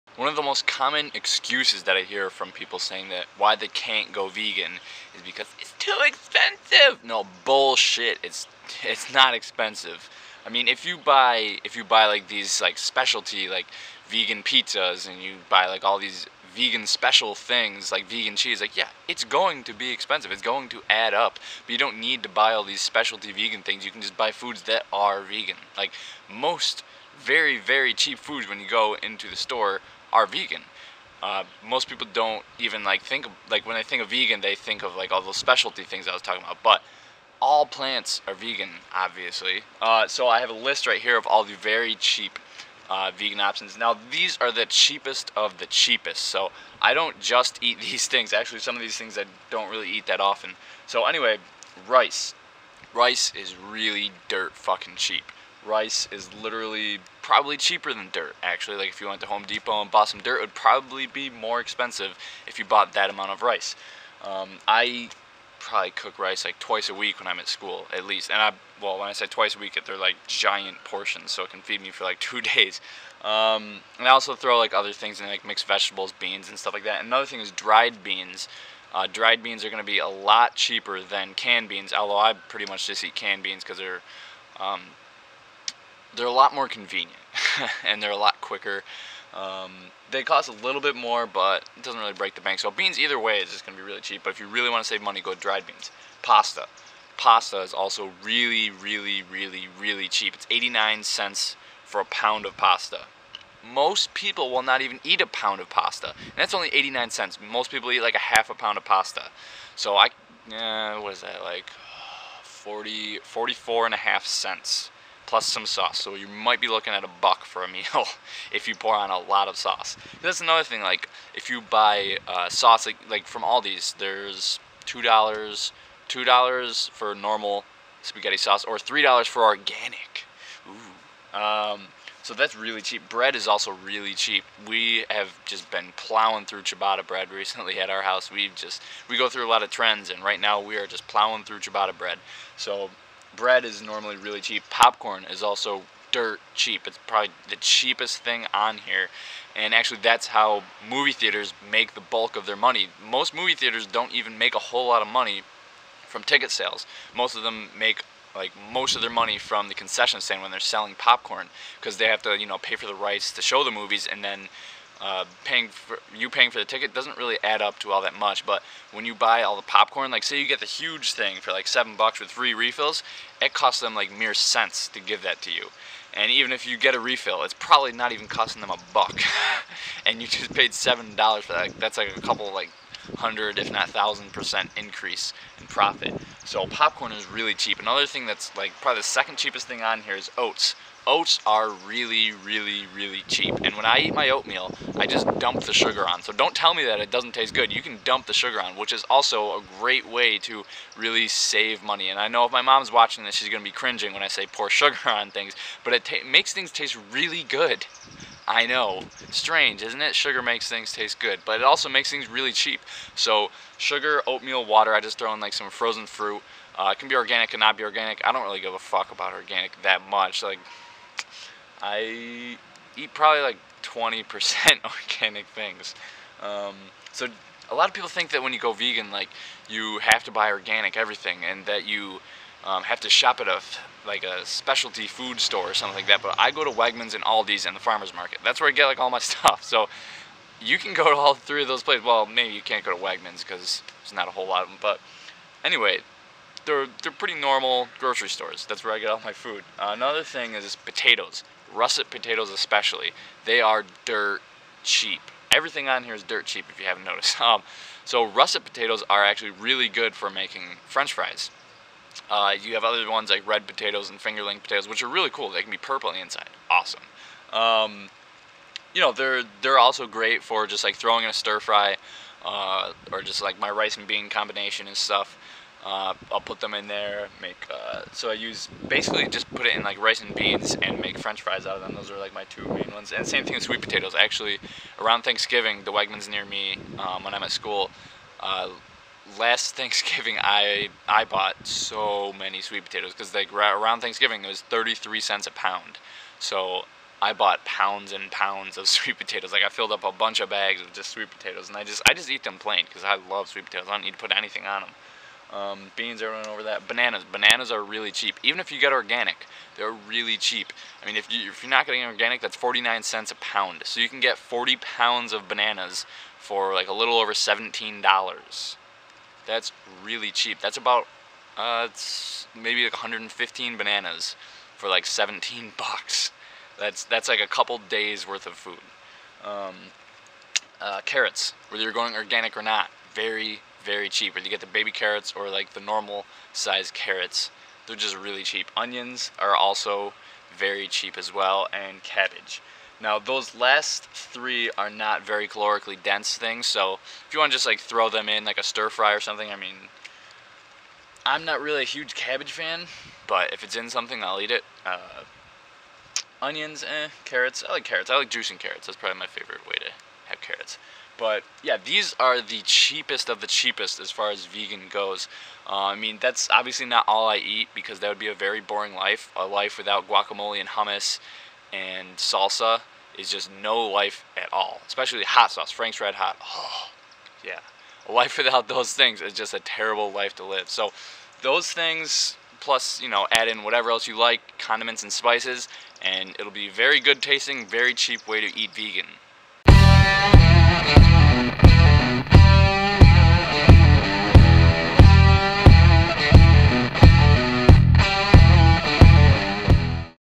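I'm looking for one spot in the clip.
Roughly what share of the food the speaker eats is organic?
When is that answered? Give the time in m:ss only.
3:43.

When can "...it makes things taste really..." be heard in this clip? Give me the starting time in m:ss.
3:25.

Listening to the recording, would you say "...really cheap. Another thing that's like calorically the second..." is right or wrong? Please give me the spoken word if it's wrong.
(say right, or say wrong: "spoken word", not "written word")
wrong: "probably", not "calorically".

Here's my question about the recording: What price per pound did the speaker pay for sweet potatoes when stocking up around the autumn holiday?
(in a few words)
33 cents.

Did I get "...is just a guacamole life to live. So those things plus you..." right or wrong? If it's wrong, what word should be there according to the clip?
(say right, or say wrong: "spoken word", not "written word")
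wrong: "terrible", not "guacamole".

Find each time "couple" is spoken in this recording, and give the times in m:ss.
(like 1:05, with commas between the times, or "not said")
3:02, 5:27.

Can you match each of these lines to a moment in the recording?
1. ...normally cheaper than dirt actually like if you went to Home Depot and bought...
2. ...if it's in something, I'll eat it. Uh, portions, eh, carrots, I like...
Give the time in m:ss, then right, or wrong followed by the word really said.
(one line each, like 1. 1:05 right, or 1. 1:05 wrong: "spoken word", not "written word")
1. 0:57 wrong: "probably", not "normally"
2. 5:53 wrong: "onions", not "portions".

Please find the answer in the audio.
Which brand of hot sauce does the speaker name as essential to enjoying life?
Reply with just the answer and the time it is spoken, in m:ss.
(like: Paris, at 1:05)
Frank's Red Hot, at 6:15.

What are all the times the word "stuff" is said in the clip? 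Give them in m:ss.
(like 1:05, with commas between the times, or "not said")
1:16, 3:59, 4:34.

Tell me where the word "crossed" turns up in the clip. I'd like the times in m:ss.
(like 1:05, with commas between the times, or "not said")
not said.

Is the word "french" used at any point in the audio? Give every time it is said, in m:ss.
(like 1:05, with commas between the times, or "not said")
4:20, 4:41.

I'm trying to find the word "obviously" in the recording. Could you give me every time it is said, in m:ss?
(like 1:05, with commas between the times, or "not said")
0:38, 6:06.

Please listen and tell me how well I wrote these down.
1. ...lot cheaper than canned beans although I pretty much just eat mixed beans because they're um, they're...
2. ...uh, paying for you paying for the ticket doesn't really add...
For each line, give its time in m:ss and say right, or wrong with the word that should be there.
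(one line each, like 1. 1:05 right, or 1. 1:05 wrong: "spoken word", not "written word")
1. 1:20 wrong: "canned", not "mixed"
2. 2:45 right.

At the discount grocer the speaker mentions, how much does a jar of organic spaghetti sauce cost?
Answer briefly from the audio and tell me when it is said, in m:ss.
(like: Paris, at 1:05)
$3, at 2:08.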